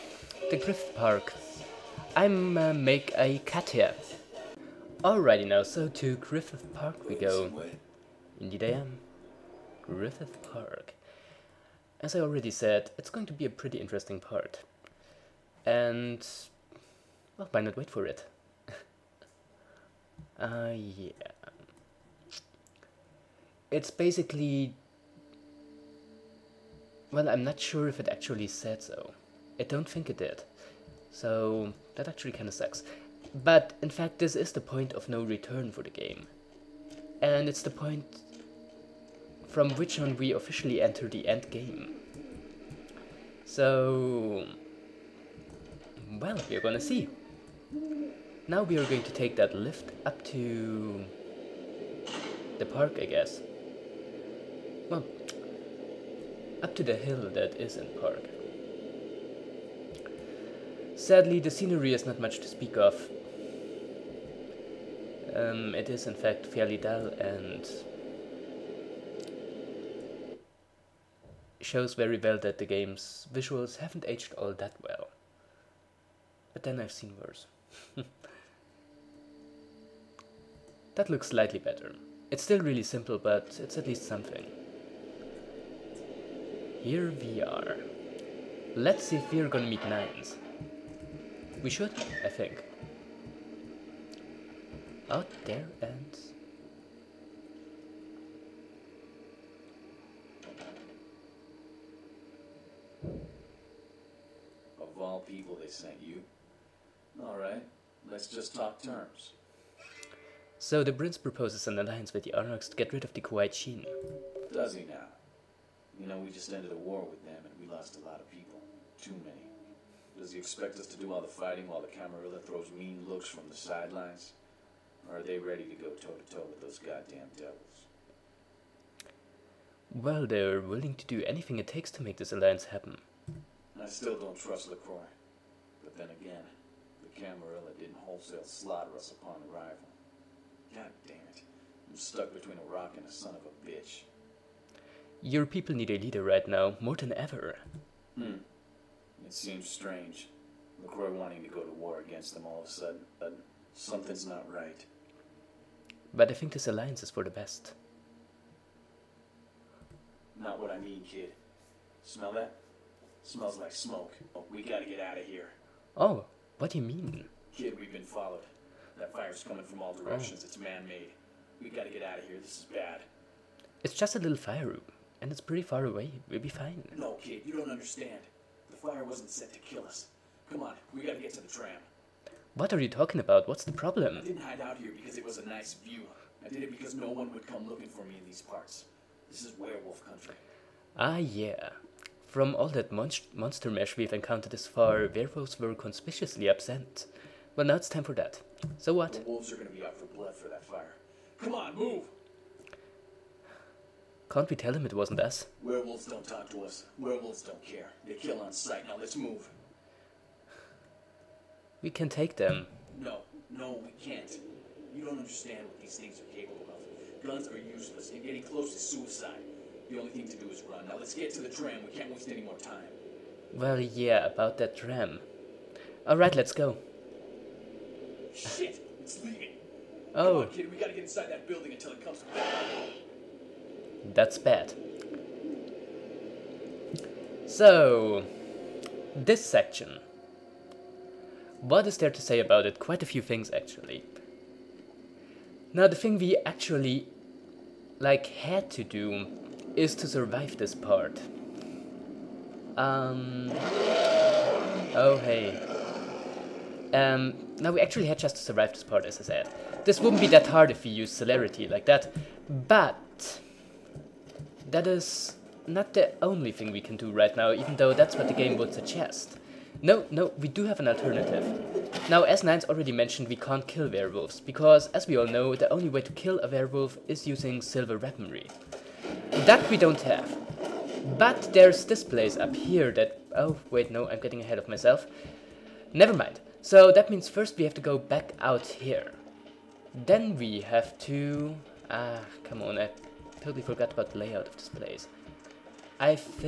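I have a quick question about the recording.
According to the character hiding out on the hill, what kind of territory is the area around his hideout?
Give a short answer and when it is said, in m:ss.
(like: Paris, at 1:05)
Werewolf country, at 3:09.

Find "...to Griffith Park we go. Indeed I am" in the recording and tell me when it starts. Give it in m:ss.
0:05.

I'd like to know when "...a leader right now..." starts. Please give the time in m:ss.
2:25.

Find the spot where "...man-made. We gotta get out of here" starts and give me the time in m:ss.
2:50.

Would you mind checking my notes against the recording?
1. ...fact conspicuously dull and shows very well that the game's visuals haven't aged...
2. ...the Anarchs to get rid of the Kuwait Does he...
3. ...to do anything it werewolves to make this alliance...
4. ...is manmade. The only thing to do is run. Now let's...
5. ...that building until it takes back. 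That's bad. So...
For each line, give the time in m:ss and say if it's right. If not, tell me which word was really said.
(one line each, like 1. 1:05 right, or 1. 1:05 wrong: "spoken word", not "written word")
1. 1:06 wrong: "fairly", not "conspicuously"
2. 1:52 right
3. 2:10 wrong: "takes", not "werewolves"
4. 3:38 wrong: "suicide", not "manmade"
5. 3:51 wrong: "comes", not "takes".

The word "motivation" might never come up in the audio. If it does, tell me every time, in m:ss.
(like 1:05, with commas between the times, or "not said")
not said.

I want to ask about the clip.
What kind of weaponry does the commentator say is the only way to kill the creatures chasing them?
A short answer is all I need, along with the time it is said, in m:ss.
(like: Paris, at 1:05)
Silver weaponry, at 4:37.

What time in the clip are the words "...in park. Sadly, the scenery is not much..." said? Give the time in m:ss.
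0:57.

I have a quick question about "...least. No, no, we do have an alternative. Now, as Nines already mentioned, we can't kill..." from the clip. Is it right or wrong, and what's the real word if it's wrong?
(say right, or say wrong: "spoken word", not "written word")
wrong: "suggest", not "least".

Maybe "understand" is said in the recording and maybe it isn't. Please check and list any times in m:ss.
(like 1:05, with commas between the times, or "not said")
2:57, 3:35.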